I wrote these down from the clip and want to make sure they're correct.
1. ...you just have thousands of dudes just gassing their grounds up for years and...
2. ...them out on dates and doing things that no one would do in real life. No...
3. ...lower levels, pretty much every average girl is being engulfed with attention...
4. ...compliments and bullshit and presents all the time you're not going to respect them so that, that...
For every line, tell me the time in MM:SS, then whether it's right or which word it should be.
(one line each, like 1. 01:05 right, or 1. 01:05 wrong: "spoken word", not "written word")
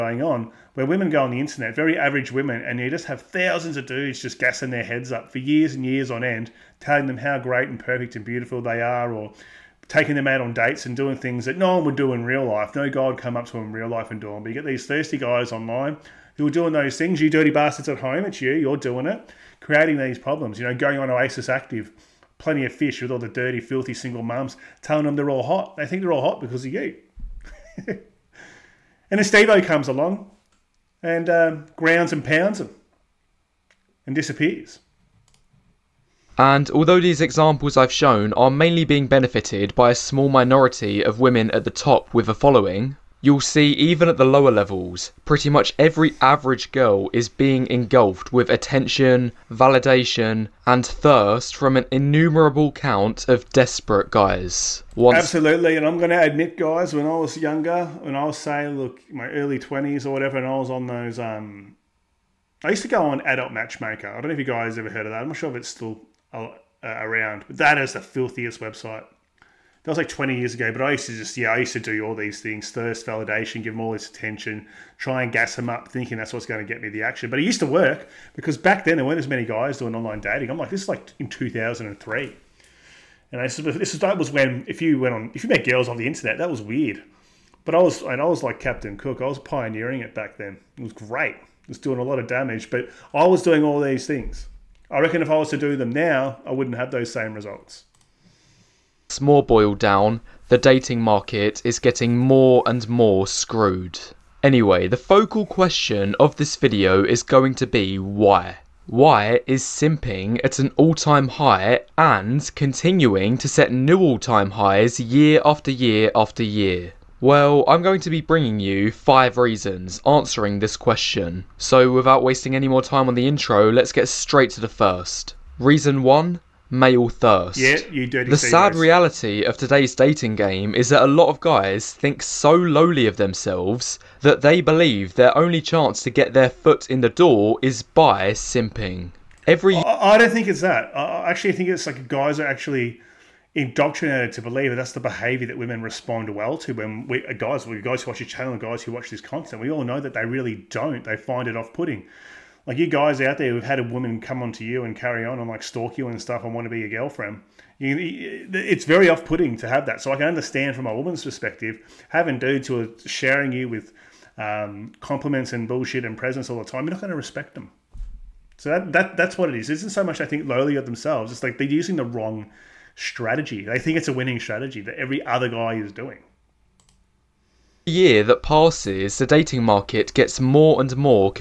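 1. 00:02 wrong: "heads", not "grounds"
2. 00:10 right
3. 00:44 right
4. 02:44 right.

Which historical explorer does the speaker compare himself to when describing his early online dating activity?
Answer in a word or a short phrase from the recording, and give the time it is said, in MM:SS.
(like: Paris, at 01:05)
Captain Cook, at 01:28.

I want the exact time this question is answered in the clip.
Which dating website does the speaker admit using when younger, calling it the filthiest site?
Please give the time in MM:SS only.
01:03.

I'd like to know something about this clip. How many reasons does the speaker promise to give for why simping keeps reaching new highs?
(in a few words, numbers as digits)
5.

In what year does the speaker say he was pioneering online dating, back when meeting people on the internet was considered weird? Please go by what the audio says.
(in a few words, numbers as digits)
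2003.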